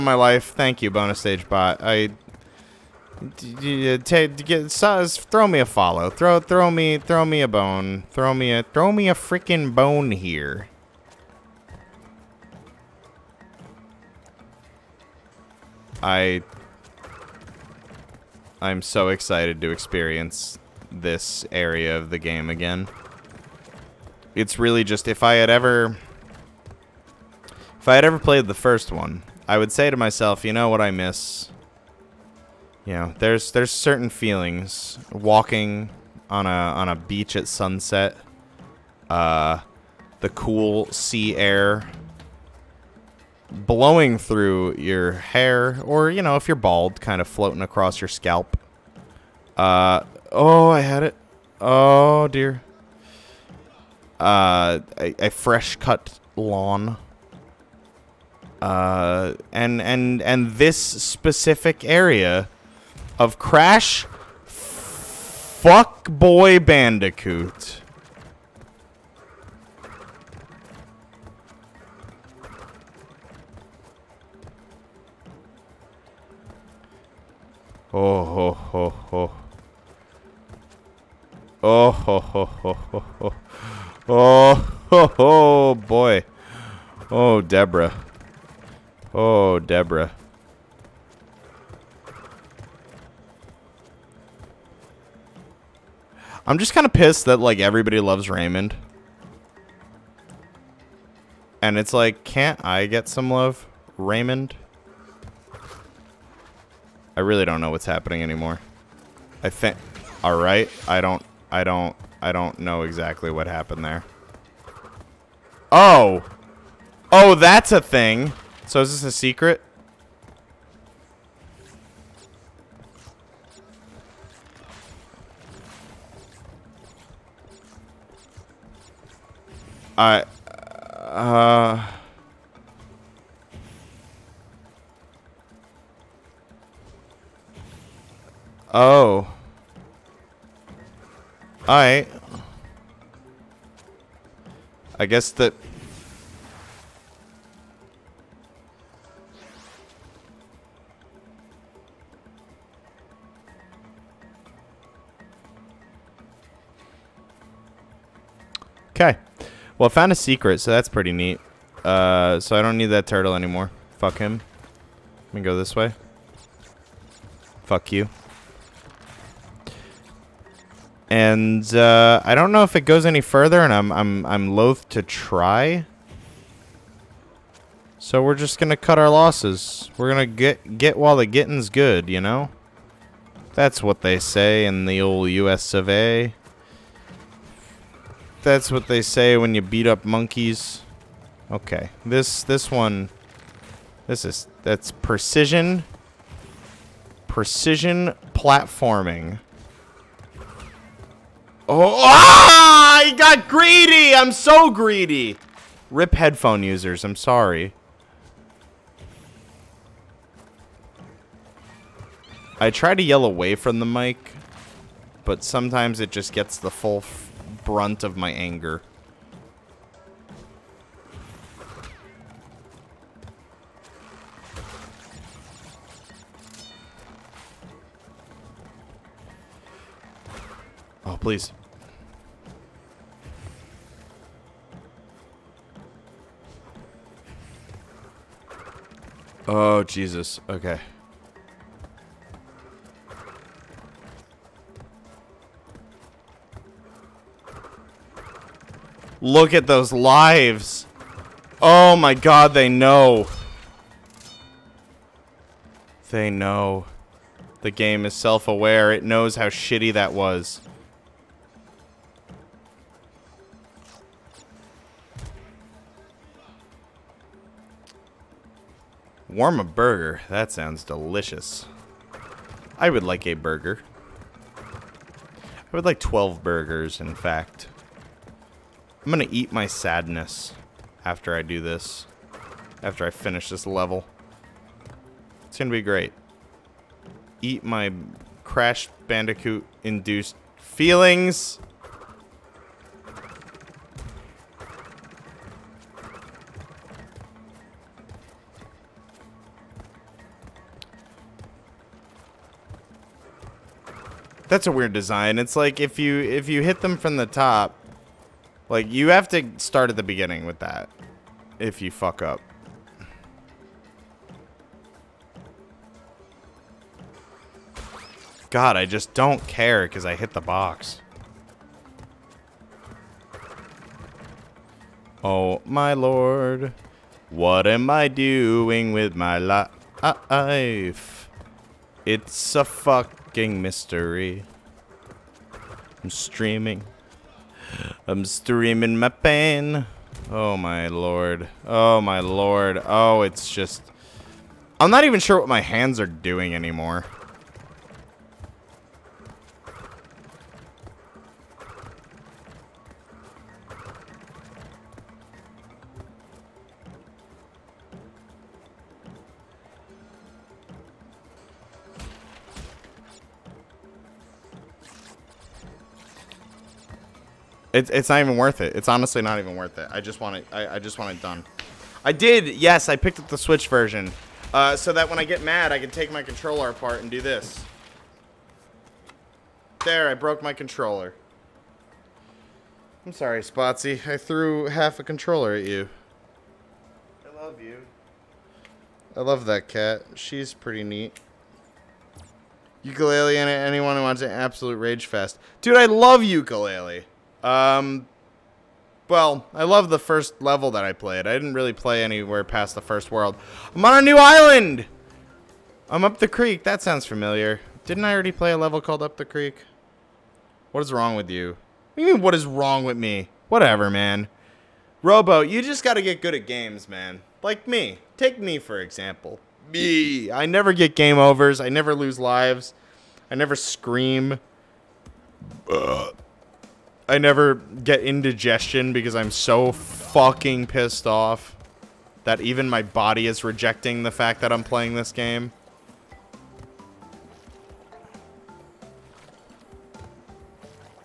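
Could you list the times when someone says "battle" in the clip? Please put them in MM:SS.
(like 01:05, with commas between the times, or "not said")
not said.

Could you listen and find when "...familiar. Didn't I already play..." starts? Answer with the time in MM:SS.
06:47.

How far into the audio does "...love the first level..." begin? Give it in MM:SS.
06:39.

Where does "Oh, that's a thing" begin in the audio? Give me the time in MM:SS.
01:57.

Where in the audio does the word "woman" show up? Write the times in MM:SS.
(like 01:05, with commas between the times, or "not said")
not said.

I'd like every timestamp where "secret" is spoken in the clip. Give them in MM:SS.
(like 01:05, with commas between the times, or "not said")
01:59, 02:40.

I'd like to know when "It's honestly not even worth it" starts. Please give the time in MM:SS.
06:08.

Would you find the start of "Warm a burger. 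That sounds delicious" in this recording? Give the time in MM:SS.
04:29.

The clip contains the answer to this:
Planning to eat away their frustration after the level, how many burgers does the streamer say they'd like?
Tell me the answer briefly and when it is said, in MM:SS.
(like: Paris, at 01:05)
12, at 04:35.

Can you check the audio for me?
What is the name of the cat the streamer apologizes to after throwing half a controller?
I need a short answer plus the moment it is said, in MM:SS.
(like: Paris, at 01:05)
Spotsy, at 06:23.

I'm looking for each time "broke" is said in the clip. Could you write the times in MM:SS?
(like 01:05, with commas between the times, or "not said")
06:20.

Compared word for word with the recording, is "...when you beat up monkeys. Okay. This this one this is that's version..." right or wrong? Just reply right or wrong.
wrong.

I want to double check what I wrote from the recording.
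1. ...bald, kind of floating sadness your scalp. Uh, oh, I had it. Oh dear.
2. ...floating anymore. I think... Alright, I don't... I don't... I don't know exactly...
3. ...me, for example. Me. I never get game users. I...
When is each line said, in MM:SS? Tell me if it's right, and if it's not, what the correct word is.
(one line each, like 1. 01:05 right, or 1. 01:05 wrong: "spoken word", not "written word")
1. 00:46 wrong: "across", not "sadness"
2. 01:47 wrong: "happening", not "floating"
3. 06:58 wrong: "overs", not "users".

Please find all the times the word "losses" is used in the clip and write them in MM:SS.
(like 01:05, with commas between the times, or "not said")
02:59.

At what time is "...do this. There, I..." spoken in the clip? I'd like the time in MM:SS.
06:17.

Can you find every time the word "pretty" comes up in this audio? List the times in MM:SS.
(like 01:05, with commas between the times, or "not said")
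02:40, 06:30.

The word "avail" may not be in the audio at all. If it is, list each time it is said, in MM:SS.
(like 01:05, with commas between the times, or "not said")
not said.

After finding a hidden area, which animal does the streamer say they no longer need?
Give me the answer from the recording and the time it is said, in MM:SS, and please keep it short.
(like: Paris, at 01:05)
Turtle, at 02:43.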